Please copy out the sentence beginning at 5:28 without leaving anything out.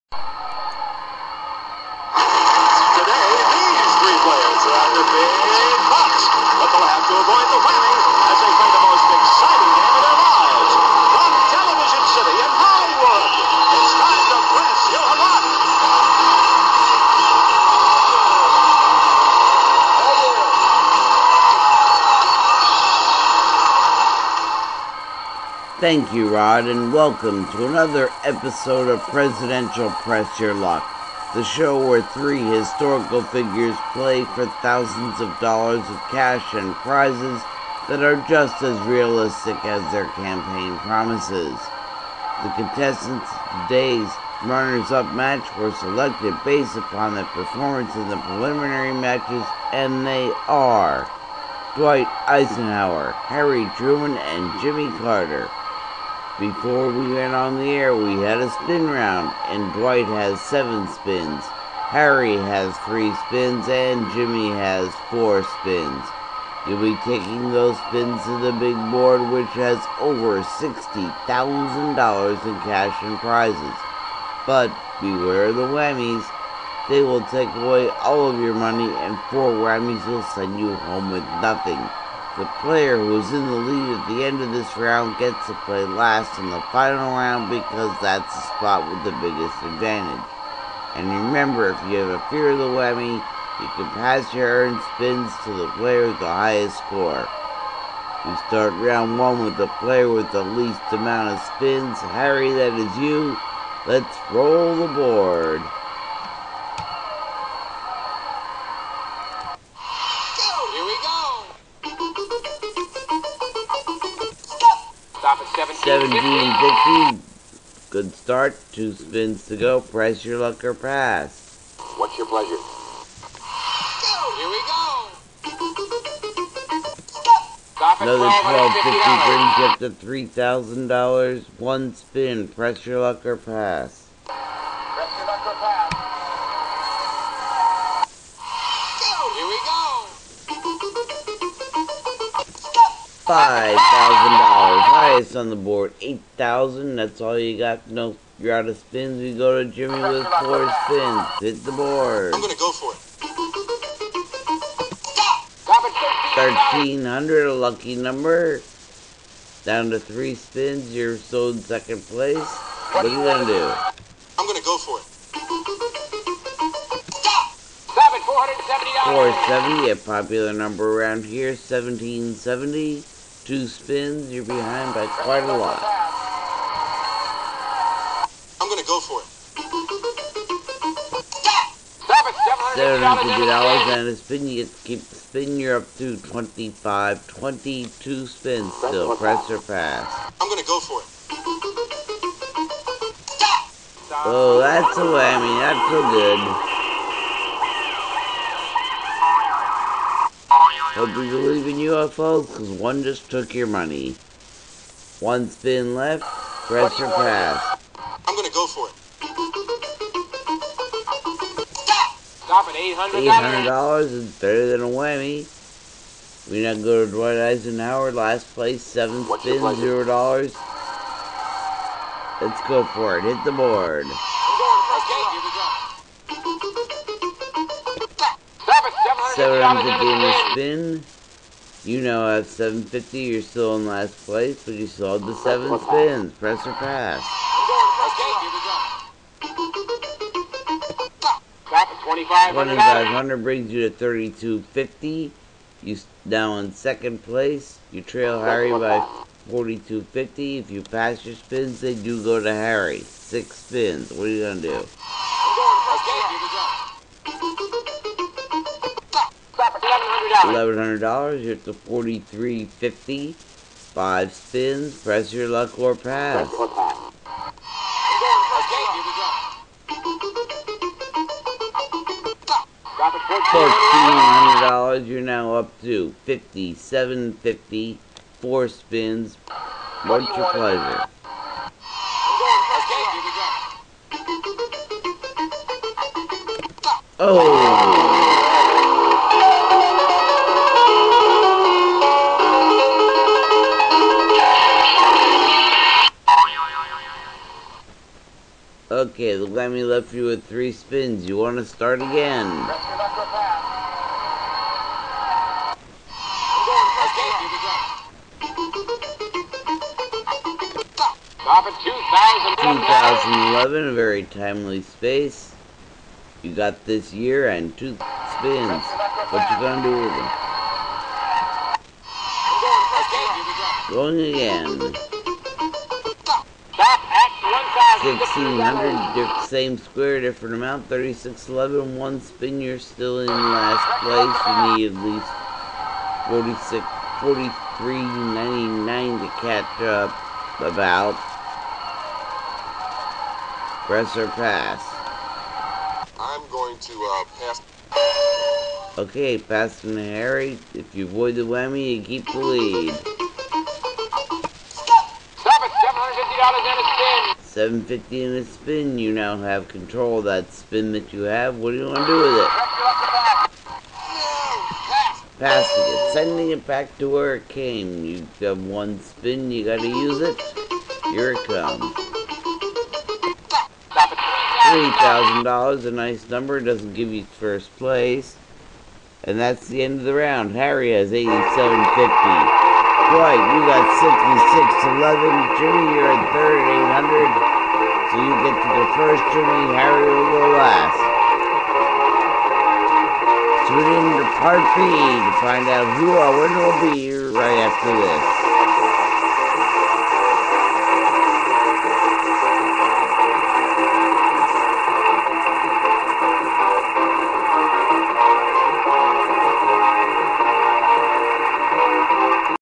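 1600, same square, different amount, 3611, one spin, you're still in last place.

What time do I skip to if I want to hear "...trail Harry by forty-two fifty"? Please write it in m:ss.
4:08.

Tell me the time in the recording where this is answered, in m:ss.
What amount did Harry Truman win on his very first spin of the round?
1:55.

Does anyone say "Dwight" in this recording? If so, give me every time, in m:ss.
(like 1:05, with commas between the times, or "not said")
0:51, 0:59, 3:37.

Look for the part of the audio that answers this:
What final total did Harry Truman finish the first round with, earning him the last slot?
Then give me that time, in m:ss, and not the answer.
6:21.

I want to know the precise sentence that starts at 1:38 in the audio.
You start round one with the player with the least amount of spins.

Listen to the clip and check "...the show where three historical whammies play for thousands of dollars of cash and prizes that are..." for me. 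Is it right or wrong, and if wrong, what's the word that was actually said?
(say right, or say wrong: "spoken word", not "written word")
wrong: "figures", not "whammies".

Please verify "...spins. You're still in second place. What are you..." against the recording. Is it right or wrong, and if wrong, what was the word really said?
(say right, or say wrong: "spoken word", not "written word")
right.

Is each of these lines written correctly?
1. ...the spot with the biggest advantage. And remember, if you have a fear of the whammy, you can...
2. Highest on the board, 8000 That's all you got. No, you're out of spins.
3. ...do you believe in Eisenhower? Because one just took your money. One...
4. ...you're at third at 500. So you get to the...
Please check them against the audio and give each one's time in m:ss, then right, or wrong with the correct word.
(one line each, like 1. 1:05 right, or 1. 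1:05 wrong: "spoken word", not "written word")
1. 1:28 right
2. 2:24 right
3. 3:21 wrong: "UFOs", not "Eisenhower"
4. 6:25 wrong: "800", not "500".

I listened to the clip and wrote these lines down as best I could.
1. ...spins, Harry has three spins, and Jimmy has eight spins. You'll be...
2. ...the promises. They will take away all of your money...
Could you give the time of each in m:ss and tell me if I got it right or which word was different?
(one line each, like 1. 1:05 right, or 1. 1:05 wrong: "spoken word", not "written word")
1. 1:00 wrong: "four", not "eight"
2. 1:15 wrong: "whammies", not "promises".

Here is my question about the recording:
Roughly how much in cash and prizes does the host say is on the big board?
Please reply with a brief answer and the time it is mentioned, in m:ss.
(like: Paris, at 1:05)
over $60,000, at 1:09.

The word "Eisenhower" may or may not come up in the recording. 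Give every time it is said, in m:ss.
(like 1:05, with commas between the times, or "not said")
0:52, 3:37.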